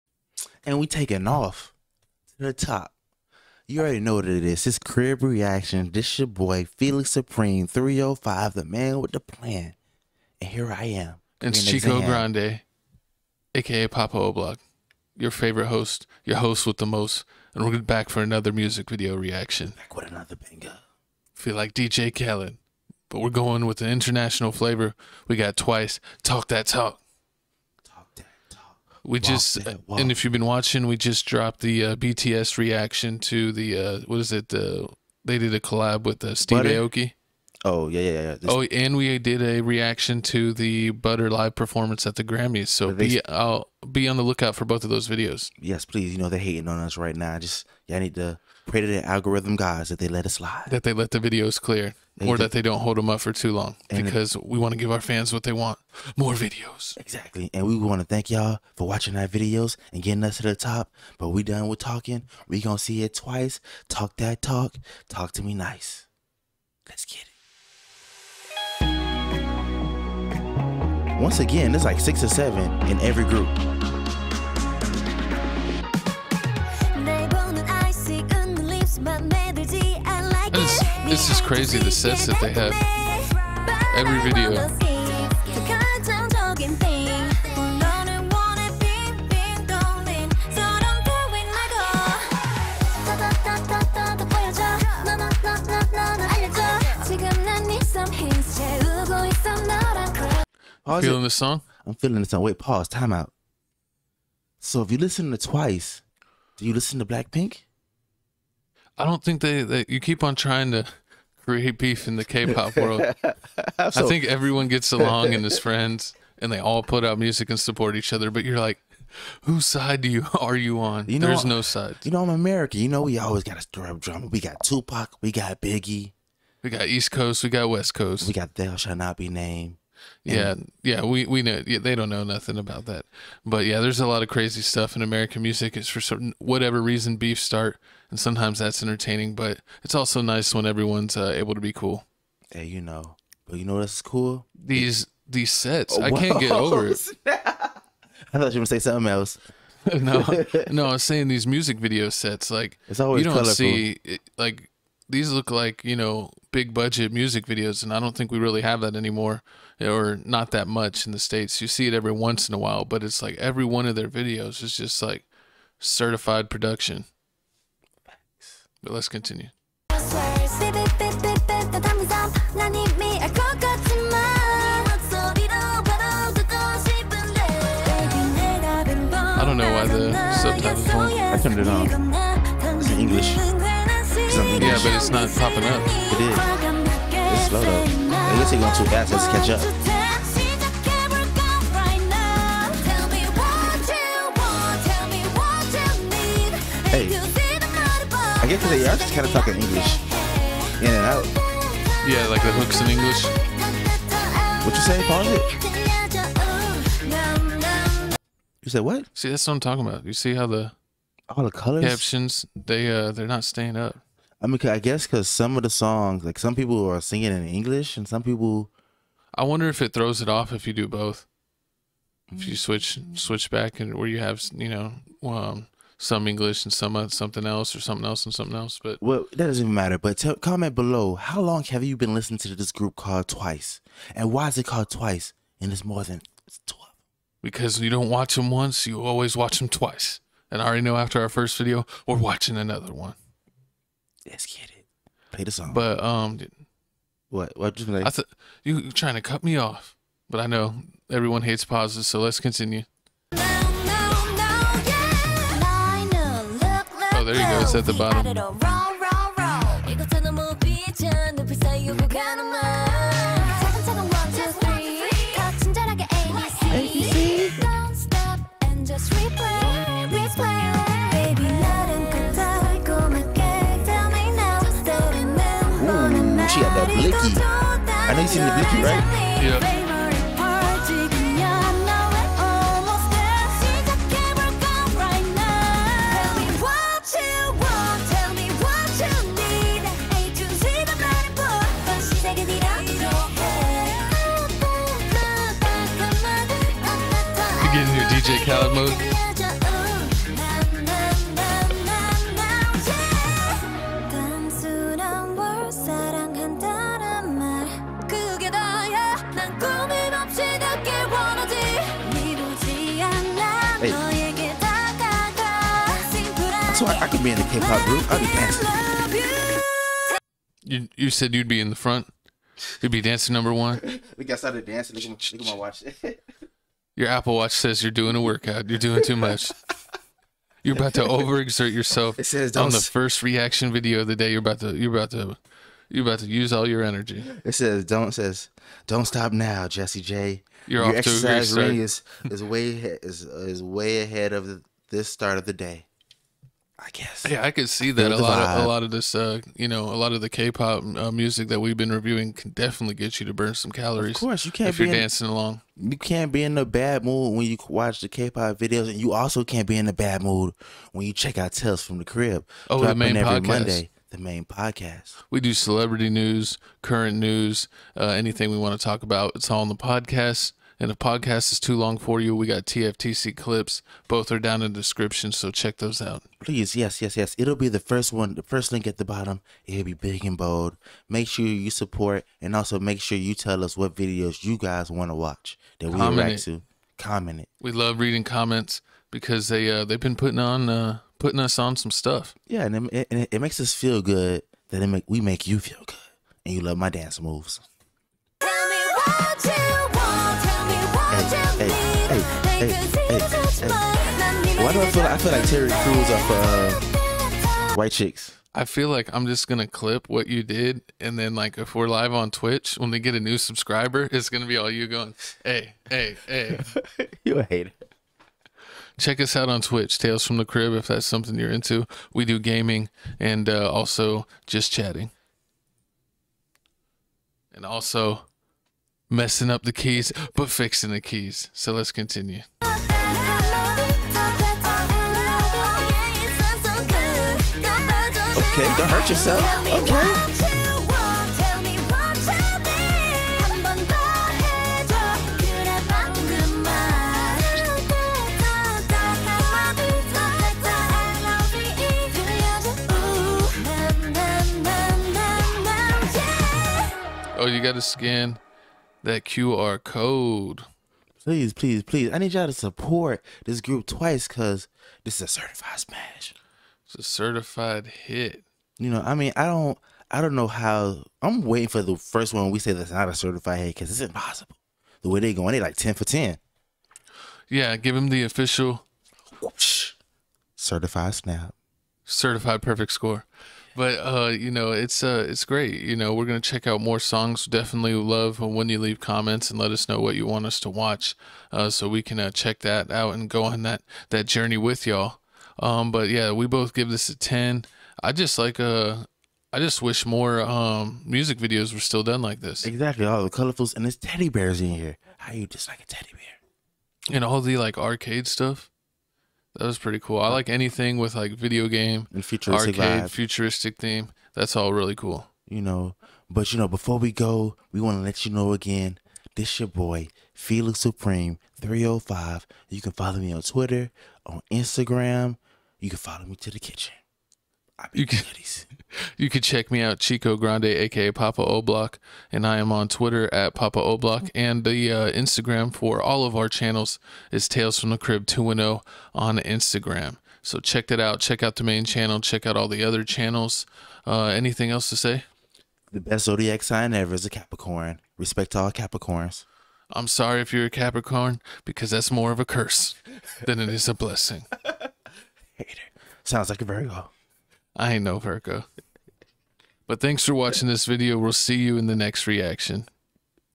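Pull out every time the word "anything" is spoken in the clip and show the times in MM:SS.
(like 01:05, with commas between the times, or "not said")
06:08, 08:30, 09:04.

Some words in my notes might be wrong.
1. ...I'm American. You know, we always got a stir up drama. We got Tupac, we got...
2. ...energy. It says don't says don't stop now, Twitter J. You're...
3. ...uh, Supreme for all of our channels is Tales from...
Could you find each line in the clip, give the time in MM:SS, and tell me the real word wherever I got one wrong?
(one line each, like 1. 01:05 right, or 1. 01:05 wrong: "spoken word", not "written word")
1. 02:02 right
2. 05:36 wrong: "Jesse", not "Twitter"
3. 08:54 wrong: "Instagram", not "Supreme".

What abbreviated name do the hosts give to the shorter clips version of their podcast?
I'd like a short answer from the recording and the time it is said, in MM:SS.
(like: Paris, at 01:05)
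TFTC clips, at 06:12.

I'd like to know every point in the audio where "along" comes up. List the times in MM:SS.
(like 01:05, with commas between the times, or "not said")
01:54, 05:55.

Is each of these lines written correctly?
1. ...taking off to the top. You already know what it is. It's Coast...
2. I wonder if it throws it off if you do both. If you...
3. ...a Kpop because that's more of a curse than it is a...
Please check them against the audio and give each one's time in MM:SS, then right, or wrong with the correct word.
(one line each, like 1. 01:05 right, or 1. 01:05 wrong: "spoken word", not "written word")
1. 00:00 wrong: "Crib", not "Coast"
2. 03:39 right
3. 09:10 wrong: "Capricorn", not "Kpop".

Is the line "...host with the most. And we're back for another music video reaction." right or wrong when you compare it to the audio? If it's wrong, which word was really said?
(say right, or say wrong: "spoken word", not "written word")
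right.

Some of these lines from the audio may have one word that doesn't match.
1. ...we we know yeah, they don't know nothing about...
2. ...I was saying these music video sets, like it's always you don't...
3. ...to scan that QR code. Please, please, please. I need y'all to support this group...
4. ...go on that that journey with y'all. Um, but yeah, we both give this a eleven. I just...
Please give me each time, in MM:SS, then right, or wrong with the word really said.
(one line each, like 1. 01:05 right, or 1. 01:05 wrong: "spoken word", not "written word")
1. 02:11 right
2. 02:30 right
3. 07:37 right
4. 08:13 wrong: "ten", not "eleven".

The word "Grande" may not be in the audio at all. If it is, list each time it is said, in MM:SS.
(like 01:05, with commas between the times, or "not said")
00:12, 08:50.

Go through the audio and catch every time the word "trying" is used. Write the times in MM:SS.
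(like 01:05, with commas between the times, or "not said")
01:50, 04:08.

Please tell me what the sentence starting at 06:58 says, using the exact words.
Check us out on Twitch, Tales from the Crib, if that's something you're into.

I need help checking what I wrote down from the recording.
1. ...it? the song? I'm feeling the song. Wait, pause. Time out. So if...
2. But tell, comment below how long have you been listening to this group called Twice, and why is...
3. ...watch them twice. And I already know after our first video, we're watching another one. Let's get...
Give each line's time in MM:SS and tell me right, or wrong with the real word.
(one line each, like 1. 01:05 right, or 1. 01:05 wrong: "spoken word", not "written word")
1. 01:41 right
2. 03:49 right
3. 03:59 right.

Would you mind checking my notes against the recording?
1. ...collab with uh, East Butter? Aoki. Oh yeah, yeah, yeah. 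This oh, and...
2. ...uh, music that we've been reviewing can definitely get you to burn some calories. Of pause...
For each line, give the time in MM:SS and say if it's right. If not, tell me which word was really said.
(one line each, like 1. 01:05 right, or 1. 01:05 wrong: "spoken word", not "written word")
1. 00:35 wrong: "Steve", not "East"
2. 05:50 wrong: "course", not "pause".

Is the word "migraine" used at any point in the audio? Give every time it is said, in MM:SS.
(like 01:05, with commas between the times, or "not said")
not said.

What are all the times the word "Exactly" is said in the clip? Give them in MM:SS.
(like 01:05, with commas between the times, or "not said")
00:56, 08:22.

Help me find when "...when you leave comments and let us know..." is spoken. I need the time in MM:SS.
08:08.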